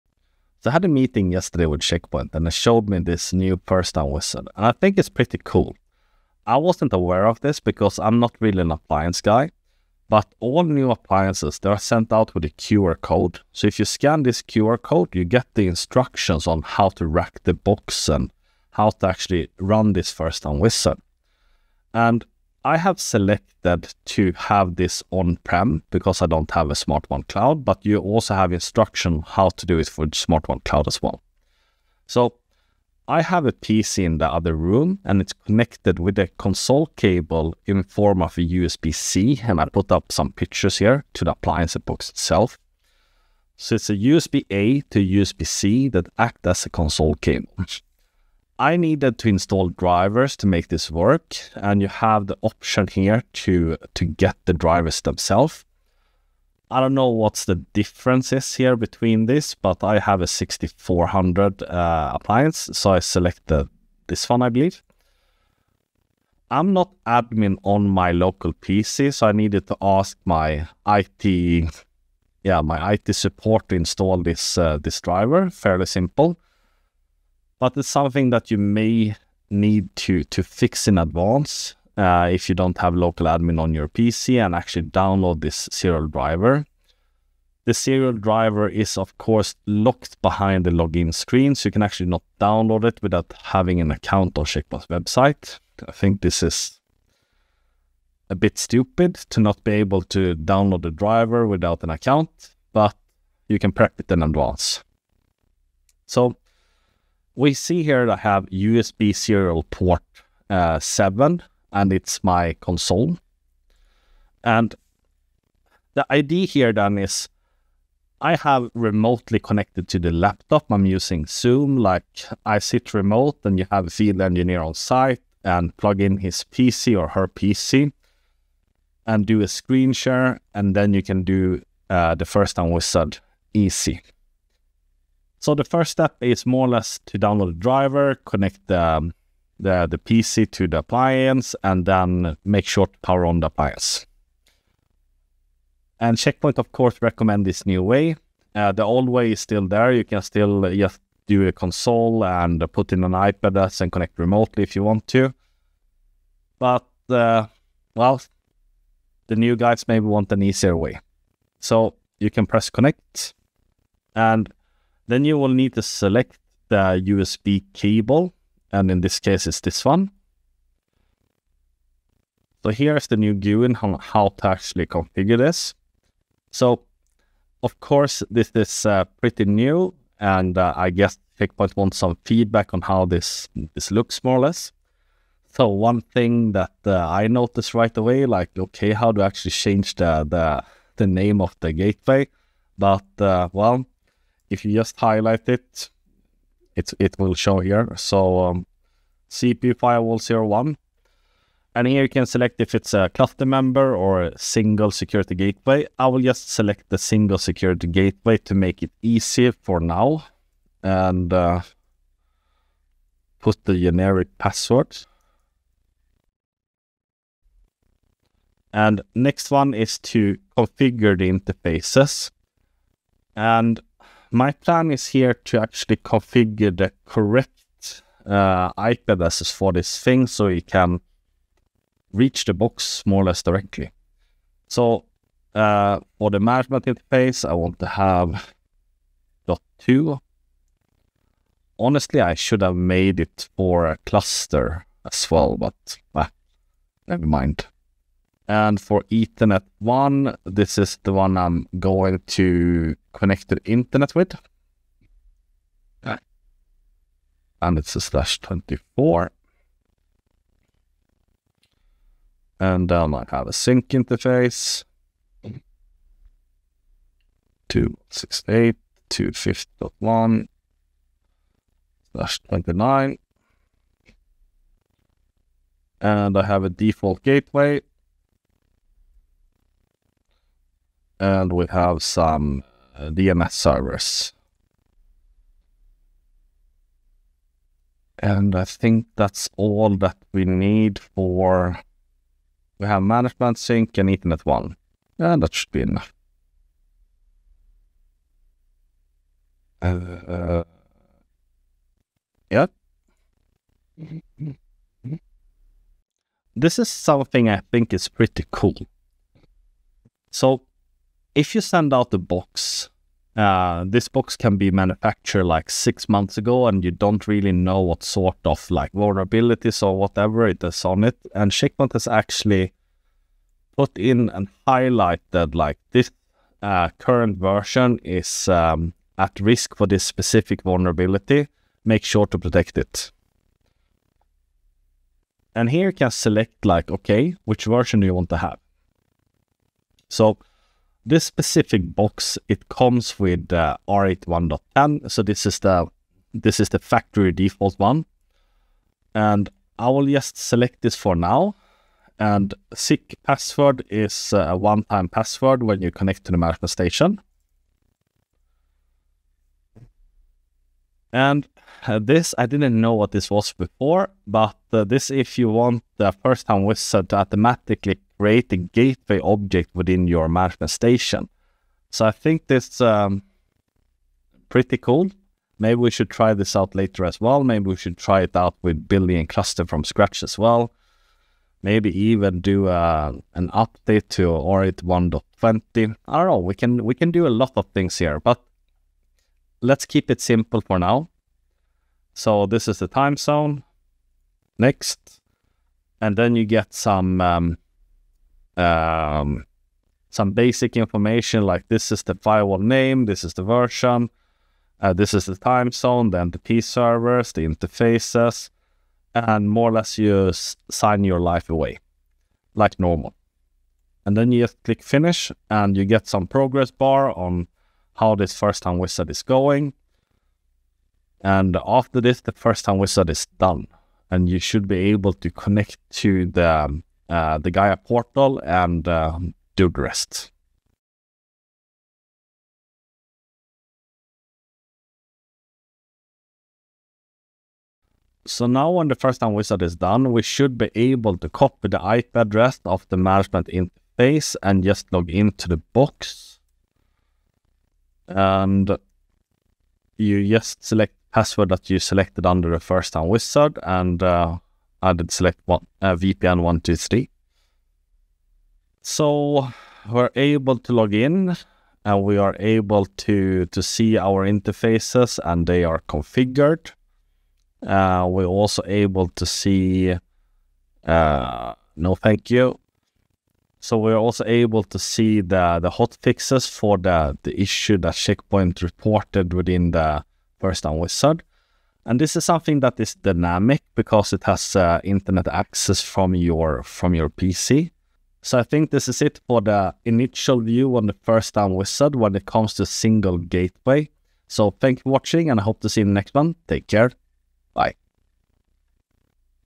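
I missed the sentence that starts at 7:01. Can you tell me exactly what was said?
And after this, the first time wizard is done.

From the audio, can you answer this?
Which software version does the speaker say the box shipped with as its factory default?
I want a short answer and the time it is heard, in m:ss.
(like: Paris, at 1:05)
R81.10, at 5:43.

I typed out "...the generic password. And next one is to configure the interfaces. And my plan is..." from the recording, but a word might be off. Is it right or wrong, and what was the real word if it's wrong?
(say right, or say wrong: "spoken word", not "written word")
right.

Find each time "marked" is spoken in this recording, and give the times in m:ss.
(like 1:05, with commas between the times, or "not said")
not said.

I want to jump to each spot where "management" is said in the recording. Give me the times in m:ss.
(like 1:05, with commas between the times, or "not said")
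3:56, 4:53, 5:56, 6:10, 7:22.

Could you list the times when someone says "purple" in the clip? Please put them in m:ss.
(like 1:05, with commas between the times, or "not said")
not said.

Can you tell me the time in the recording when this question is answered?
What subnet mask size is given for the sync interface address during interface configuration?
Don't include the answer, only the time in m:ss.
4:32.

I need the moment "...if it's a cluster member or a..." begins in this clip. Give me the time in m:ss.
3:22.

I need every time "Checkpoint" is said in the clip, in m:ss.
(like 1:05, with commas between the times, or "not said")
0:01, 1:34, 2:26, 3:01, 5:21, 7:57.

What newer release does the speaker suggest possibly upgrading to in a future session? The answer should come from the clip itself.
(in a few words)
R81.20.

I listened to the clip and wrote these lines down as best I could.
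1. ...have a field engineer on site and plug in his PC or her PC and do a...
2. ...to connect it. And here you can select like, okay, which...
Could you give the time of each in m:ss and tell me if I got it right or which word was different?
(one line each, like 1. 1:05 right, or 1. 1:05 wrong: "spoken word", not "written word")
1. 2:03 right
2. 5:32 wrong: "protect", not "connect".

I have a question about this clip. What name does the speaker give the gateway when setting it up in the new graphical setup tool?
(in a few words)
CPU firewall 01.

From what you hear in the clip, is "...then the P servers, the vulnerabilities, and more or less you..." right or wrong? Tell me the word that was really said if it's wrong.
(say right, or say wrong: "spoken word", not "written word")
wrong: "interfaces", not "vulnerabilities".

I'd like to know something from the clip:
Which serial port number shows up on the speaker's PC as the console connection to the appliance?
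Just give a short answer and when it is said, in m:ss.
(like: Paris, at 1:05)
7, at 1:50.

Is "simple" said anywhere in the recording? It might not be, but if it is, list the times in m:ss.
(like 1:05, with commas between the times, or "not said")
1:15, 6:30.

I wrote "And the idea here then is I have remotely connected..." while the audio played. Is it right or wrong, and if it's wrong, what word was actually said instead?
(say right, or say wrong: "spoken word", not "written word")
right.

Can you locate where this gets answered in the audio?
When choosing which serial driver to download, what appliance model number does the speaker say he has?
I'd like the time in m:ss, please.
1:00.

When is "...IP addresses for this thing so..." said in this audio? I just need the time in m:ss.
3:48.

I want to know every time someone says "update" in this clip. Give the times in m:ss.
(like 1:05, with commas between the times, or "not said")
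6:23.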